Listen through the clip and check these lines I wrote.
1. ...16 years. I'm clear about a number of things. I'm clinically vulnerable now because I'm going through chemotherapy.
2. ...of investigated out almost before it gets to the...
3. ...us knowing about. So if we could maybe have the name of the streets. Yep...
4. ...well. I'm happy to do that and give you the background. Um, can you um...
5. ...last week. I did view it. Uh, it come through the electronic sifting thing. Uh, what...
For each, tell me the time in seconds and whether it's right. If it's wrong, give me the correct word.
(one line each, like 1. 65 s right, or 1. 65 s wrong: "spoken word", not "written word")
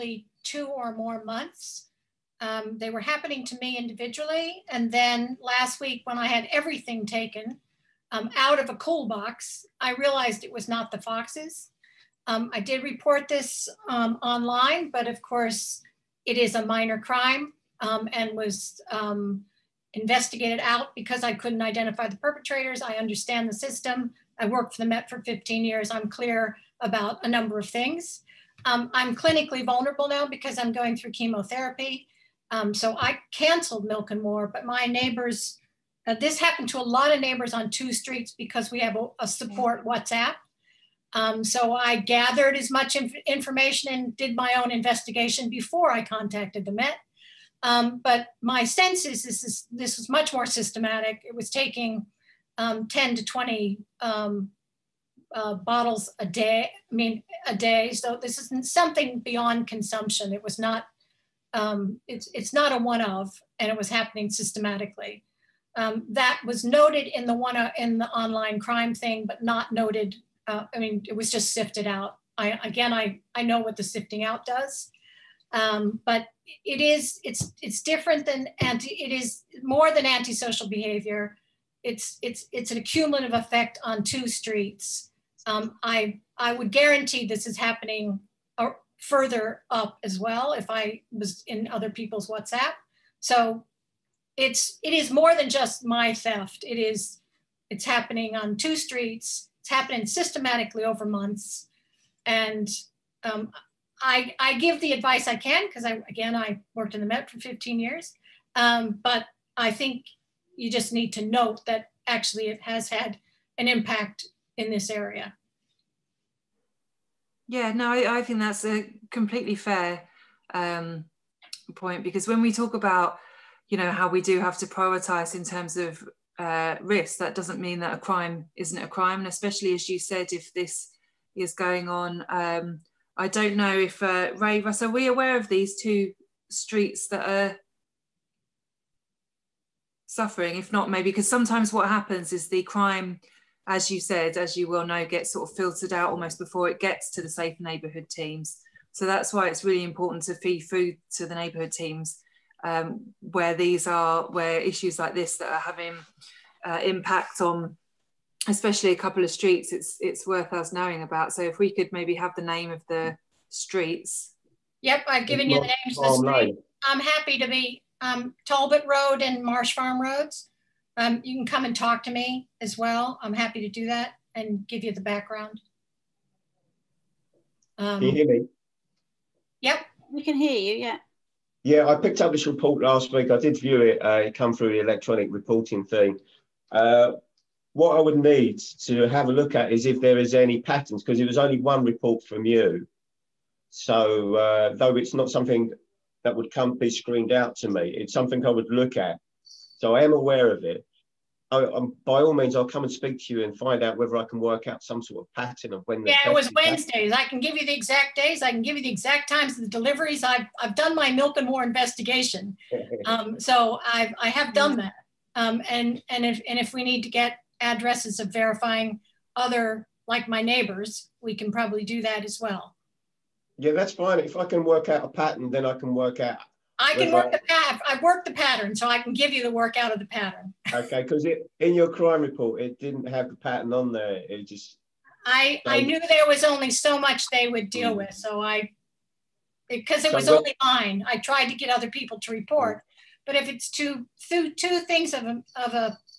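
1. 25 s wrong: "15", not "16"
2. 145 s wrong: "filtered", not "investigated"
3. 160 s right
4. 172 s right
5. 182 s wrong: "reporting", not "sifting".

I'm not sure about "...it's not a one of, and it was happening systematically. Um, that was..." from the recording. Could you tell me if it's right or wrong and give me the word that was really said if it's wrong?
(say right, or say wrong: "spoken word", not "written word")
right.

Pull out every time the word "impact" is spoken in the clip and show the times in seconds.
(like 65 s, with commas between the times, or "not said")
113 s, 156 s.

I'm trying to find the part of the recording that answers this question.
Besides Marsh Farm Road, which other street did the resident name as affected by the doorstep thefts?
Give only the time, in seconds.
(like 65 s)
168 s.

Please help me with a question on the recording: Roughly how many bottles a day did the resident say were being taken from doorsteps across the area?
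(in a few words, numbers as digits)
10 to 20.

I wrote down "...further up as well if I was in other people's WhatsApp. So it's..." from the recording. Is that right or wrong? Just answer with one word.
right.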